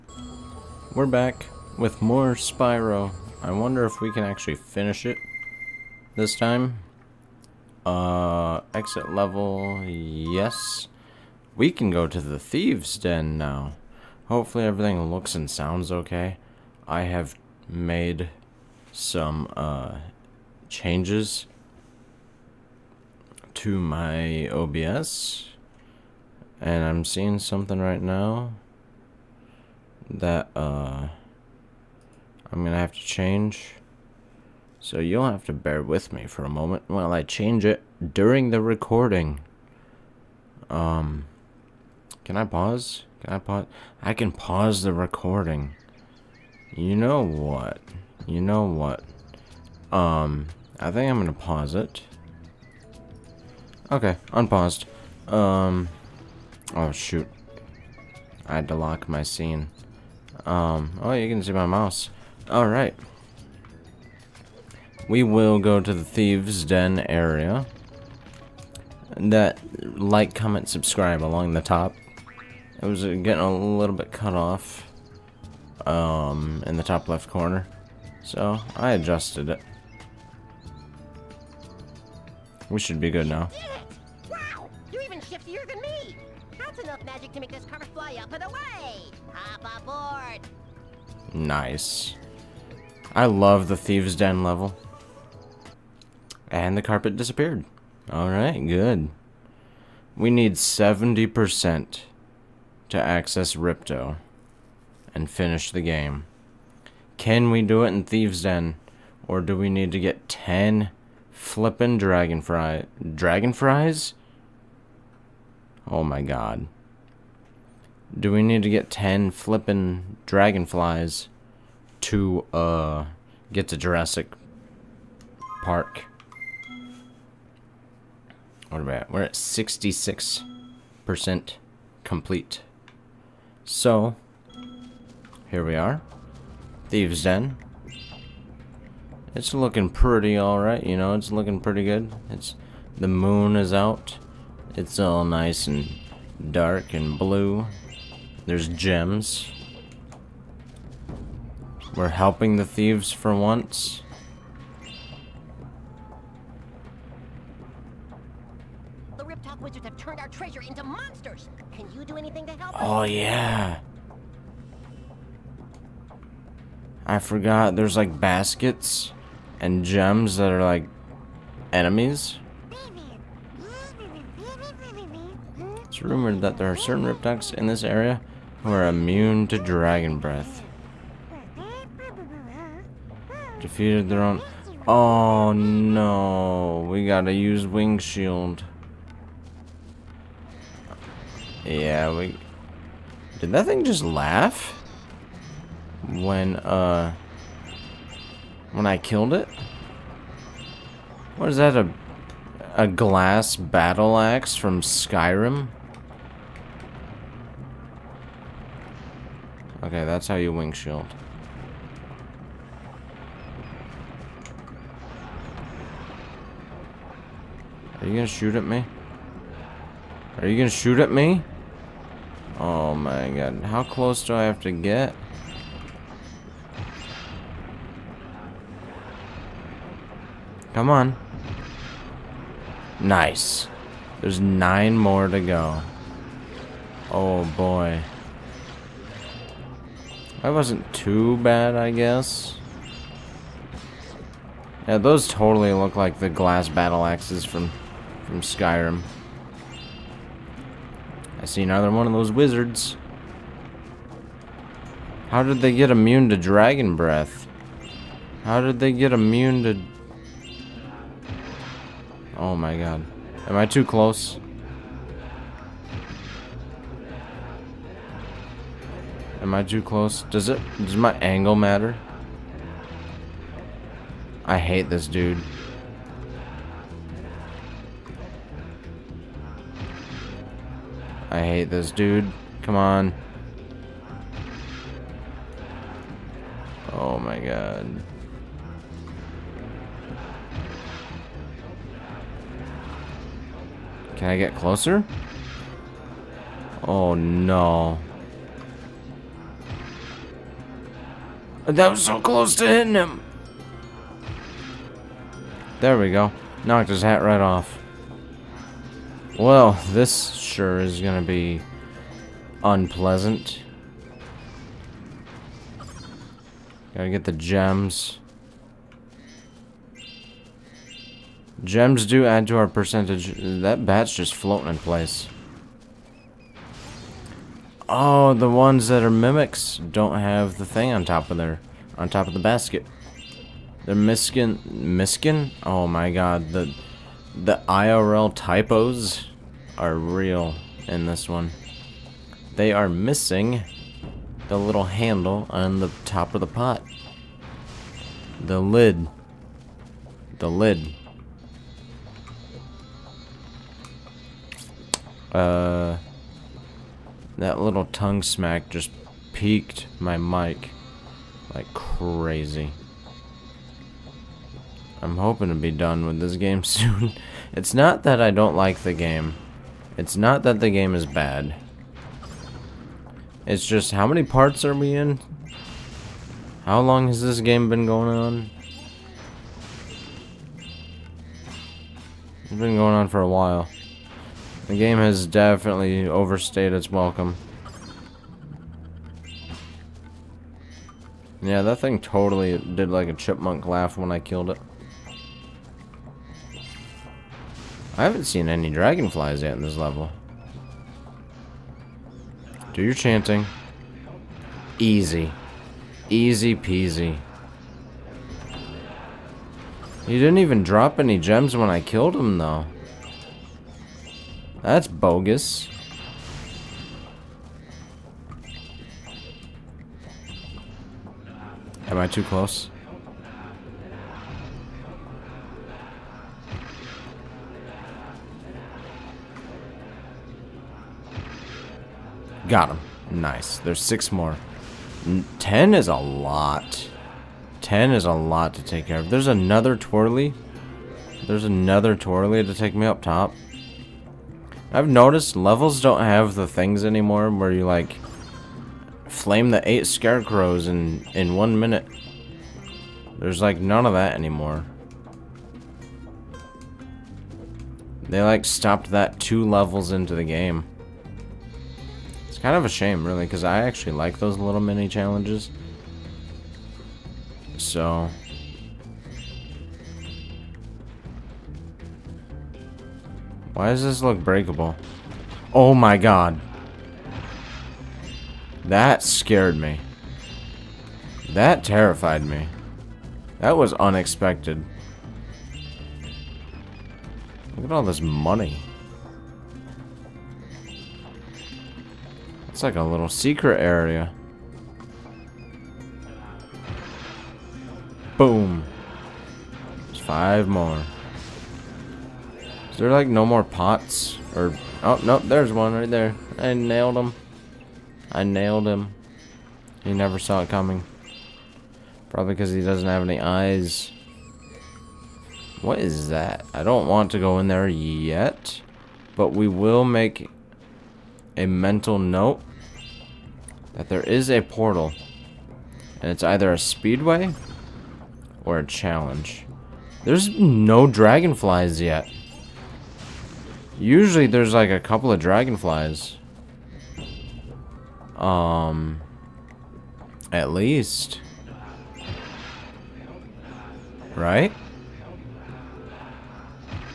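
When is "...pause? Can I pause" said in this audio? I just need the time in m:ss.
0:42.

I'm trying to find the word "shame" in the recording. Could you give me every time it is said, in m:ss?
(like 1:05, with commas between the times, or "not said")
7:42.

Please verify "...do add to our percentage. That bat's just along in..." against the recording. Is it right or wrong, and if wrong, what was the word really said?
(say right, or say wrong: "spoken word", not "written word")
wrong: "floating", not "along".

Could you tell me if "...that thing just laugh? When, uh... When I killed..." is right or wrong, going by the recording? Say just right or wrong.
right.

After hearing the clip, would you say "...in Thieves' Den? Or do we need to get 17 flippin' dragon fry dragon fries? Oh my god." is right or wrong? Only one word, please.
wrong.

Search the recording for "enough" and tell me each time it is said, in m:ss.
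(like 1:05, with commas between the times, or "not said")
1:26.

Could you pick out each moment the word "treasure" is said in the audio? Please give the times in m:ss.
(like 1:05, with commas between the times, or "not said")
2:40.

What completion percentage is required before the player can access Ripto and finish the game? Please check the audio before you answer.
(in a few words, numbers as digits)
70%.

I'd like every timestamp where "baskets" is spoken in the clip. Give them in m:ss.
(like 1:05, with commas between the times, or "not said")
2:48, 5:32.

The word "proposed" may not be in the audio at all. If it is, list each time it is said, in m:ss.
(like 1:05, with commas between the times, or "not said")
not said.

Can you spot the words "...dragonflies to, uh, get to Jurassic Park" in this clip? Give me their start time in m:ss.
2:00.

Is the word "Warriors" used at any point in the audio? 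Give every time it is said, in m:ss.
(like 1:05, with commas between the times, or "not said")
not said.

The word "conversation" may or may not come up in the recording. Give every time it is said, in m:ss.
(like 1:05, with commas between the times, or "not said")
not said.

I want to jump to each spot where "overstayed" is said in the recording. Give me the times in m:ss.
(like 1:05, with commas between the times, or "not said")
6:26.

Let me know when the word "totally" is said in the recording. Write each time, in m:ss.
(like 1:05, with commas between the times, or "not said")
4:05, 6:31.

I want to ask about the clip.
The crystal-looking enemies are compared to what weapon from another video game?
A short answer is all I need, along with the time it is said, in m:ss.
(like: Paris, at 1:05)
glass battle axe, at 4:06.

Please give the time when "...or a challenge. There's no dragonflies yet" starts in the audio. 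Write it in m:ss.
8:48.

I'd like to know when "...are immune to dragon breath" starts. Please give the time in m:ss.
2:58.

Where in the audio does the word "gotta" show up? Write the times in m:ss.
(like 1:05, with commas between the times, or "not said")
3:07, 5:16.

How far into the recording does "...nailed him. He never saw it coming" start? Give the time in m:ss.
8:28.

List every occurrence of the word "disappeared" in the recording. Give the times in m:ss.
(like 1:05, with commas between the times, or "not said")
1:37.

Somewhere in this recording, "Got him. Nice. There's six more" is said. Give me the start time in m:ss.
7:12.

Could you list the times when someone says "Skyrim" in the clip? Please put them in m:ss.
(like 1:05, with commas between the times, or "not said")
3:24, 4:08.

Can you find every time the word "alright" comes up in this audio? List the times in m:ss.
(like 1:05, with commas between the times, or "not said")
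1:02, 1:38, 2:20.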